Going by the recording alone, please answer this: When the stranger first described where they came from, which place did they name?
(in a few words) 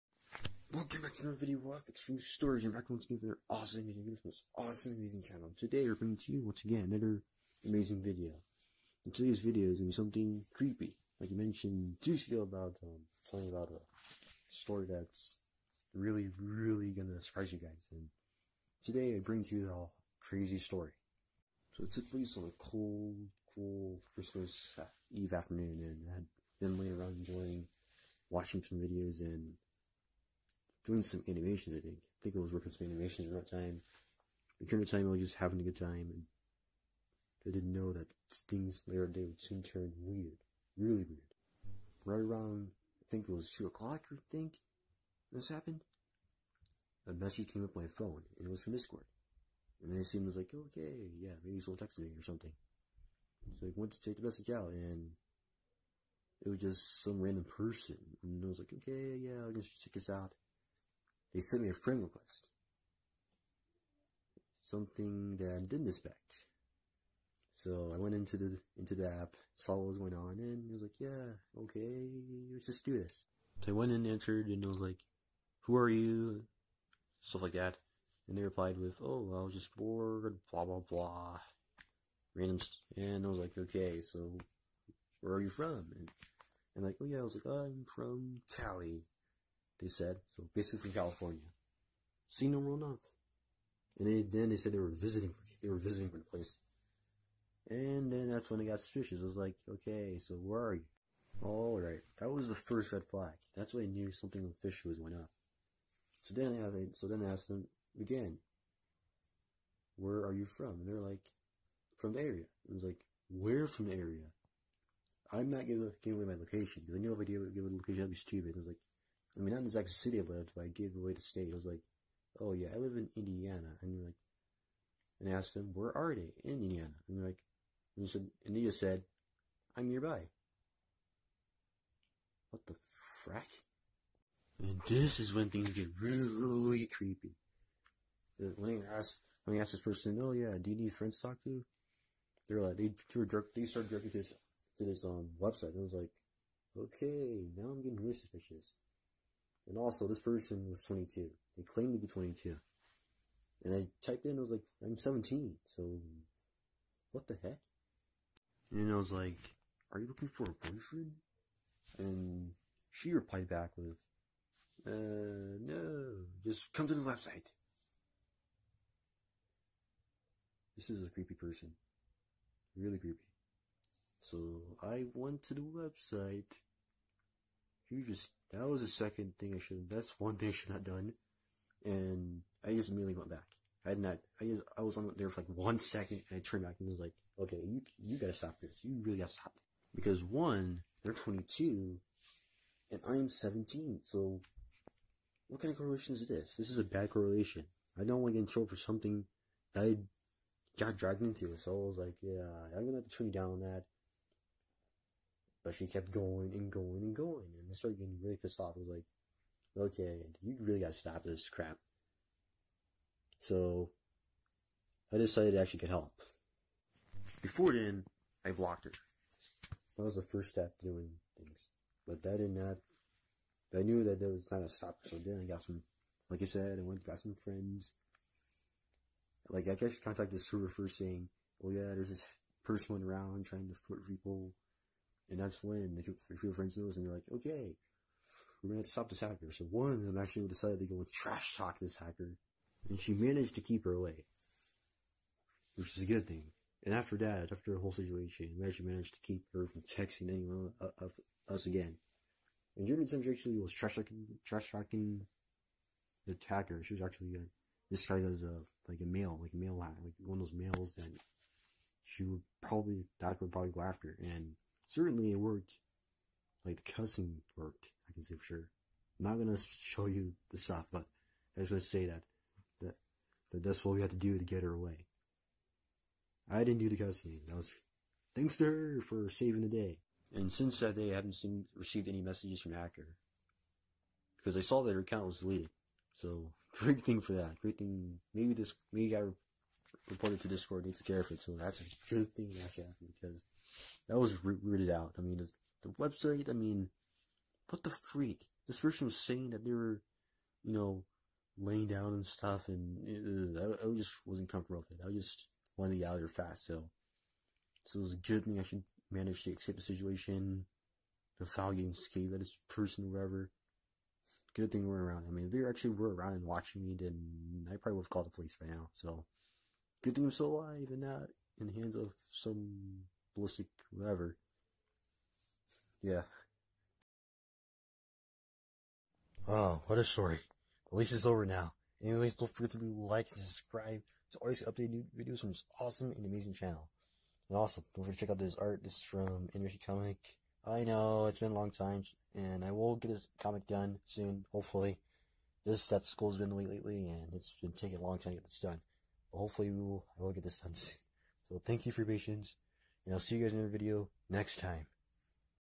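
Cali.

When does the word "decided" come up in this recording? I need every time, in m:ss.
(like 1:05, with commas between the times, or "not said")
3:35, 4:00.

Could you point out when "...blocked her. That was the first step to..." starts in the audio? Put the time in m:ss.
3:38.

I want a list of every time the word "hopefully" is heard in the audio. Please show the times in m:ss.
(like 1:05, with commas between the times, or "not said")
5:44, 5:49.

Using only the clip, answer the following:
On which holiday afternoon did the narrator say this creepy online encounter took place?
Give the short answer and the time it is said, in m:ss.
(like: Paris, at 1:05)
Christmas Eve, at 0:24.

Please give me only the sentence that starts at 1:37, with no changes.
And then that's when I got suspicious.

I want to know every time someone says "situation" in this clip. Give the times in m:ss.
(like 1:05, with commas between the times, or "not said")
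4:07, 5:09.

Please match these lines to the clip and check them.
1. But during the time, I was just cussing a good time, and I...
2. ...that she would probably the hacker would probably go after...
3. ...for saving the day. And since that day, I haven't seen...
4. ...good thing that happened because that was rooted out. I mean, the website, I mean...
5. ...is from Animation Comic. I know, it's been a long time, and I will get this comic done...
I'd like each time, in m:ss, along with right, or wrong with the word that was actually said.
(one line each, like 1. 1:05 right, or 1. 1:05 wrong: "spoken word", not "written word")
1. 0:34 wrong: "having", not "cussing"
2. 4:20 right
3. 4:39 right
4. 4:52 right
5. 5:38 right.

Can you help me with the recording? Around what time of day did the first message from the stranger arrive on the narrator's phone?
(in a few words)
2 o'clock.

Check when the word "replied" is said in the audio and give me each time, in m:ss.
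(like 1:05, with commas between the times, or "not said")
1:18, 2:43.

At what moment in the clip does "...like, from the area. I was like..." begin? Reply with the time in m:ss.
1:50.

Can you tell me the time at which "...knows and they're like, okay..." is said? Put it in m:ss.
3:56.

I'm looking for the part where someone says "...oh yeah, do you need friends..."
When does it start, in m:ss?
2:20.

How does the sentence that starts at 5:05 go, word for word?
I just wanted to get out of there fast, so.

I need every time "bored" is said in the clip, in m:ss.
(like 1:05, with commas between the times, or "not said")
1:19.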